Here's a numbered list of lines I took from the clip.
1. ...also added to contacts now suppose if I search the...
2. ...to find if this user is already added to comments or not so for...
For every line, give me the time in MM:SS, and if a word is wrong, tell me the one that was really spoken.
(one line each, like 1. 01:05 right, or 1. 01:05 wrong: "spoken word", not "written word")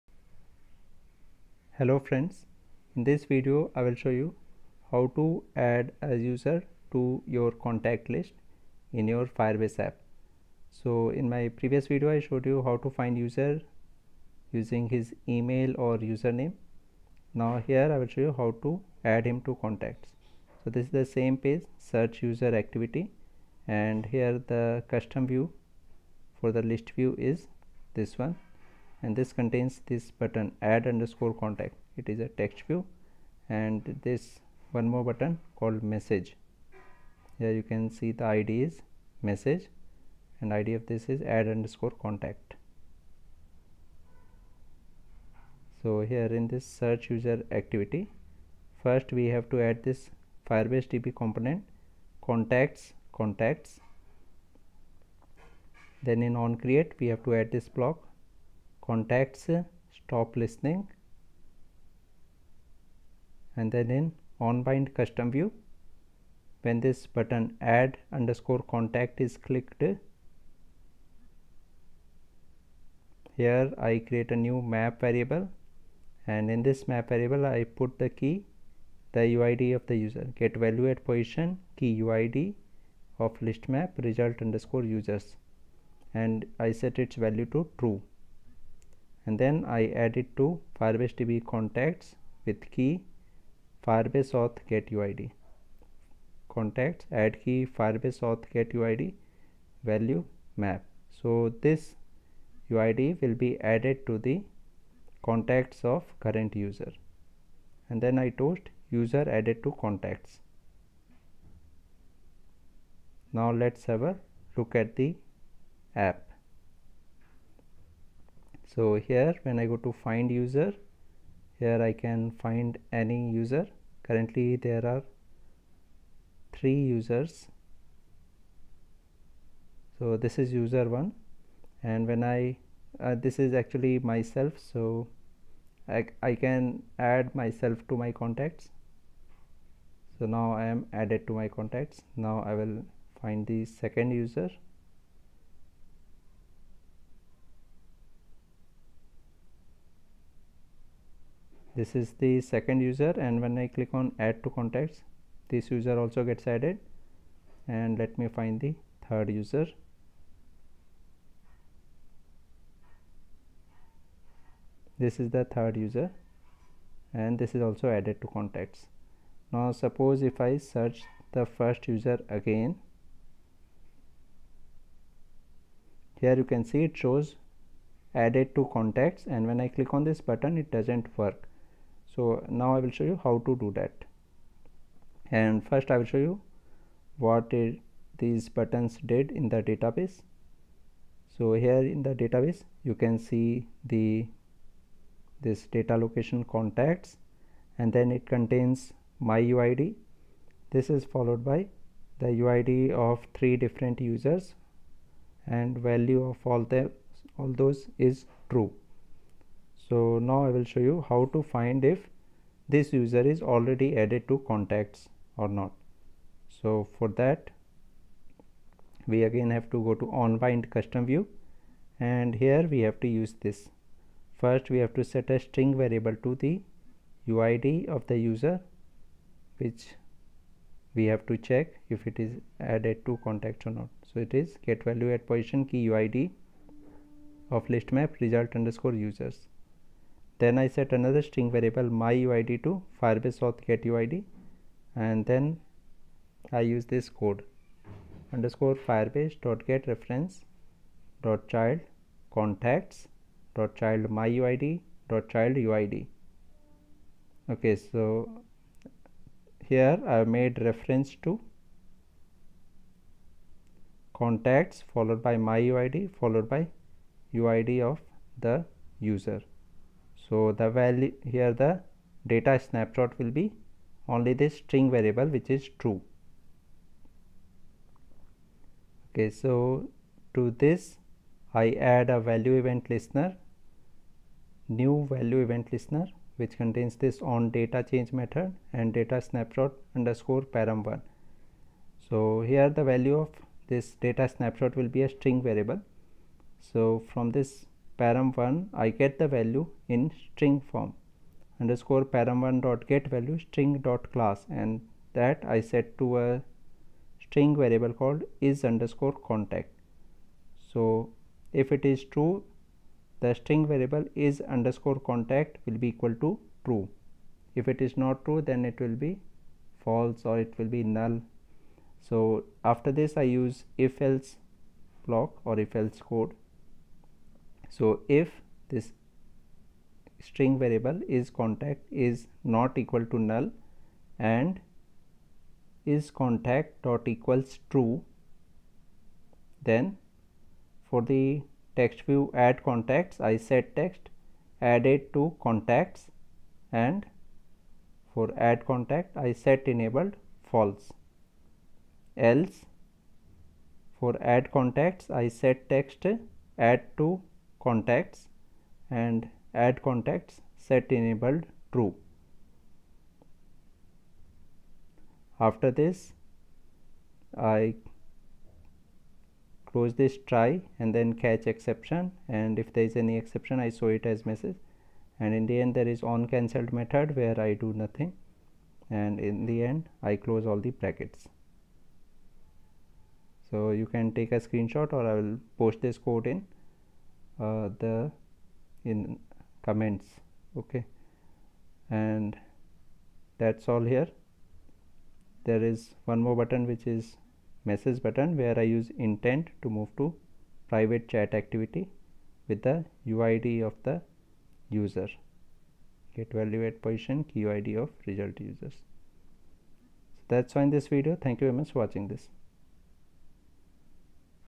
1. 02:47 right
2. 03:31 wrong: "contacts", not "comments".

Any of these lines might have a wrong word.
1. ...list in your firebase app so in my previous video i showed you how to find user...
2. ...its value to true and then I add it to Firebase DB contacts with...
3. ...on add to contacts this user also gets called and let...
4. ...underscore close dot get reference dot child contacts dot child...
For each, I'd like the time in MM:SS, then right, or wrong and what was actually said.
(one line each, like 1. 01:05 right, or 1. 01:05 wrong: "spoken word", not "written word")
1. 00:08 right
2. 01:27 right
3. 02:33 wrong: "added", not "called"
4. 04:08 wrong: "firebase", not "close".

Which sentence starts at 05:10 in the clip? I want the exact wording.
So if it is true the string variable is underscore contact will be equal to true.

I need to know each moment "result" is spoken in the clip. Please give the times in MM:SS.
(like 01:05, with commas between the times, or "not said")
01:24, 03:58, 06:48.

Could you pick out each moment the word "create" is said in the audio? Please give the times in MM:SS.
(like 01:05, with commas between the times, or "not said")
00:56, 01:14.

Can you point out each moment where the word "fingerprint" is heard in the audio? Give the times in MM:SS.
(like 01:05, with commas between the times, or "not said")
not said.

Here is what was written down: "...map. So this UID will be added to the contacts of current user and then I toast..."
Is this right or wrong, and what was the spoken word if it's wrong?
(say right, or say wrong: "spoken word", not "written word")
right.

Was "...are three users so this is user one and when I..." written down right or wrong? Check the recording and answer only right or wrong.
right.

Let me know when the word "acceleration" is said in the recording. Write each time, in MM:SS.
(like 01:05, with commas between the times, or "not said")
not said.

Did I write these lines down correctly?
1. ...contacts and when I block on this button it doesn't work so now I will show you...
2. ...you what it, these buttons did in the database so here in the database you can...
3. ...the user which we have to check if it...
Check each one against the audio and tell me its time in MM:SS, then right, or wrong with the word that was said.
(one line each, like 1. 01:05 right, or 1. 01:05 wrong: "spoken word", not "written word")
1. 02:58 wrong: "click", not "block"
2. 03:06 right
3. 03:48 right.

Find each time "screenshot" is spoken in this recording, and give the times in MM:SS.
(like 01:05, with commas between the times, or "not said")
06:24.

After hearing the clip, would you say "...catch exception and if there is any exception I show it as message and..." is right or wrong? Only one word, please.
right.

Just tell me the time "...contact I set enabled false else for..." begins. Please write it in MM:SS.
05:48.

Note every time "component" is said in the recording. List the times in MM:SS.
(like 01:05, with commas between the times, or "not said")
00:51.